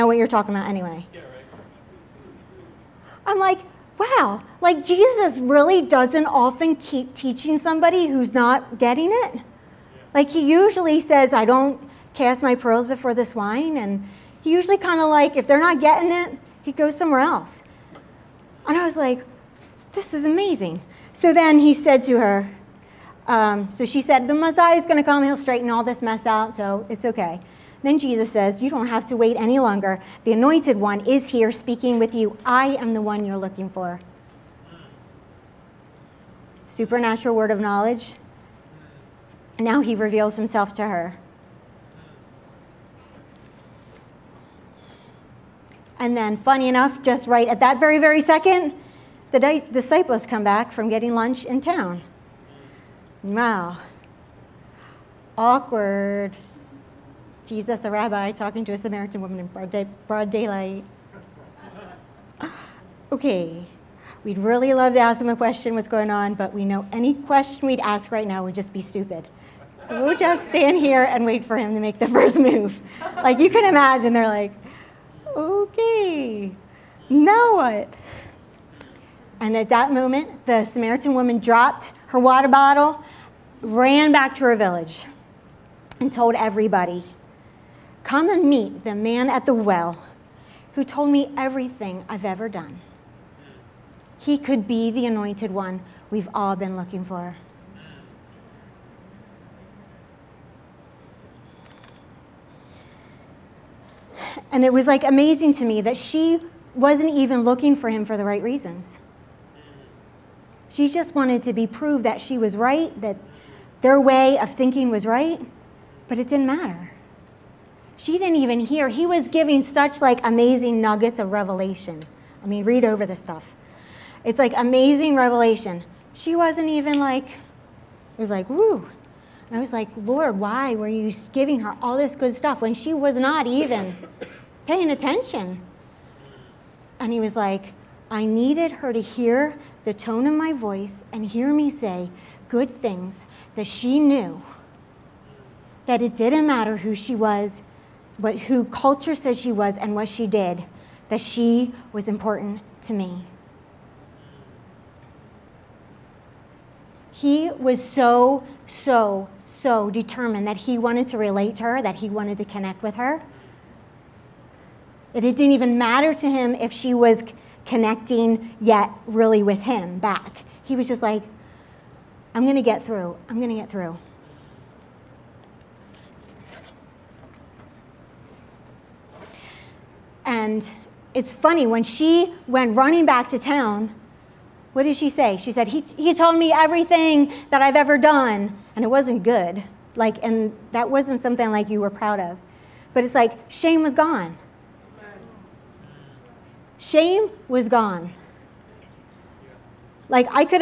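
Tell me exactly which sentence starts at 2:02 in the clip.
I mean, read over the stuff.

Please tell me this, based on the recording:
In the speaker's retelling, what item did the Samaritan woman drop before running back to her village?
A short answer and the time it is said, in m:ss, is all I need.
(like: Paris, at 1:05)
water bottle, at 1:22.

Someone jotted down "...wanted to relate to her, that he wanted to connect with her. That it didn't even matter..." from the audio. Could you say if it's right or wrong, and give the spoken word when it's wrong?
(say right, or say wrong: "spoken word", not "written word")
right.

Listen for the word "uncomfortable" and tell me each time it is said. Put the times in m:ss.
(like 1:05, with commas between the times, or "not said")
not said.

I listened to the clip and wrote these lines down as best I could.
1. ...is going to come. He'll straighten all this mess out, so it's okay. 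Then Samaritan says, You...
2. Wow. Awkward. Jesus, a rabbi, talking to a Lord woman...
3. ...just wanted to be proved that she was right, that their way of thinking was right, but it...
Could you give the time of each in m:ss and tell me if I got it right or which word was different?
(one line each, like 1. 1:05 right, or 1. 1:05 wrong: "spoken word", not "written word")
1. 0:24 wrong: "Jesus", not "Samaritan"
2. 0:53 wrong: "Samaritan", not "Lord"
3. 1:50 right.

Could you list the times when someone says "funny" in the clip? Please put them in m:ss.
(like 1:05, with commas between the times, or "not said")
0:46, 3:01.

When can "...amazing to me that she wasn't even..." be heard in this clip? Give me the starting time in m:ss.
1:45.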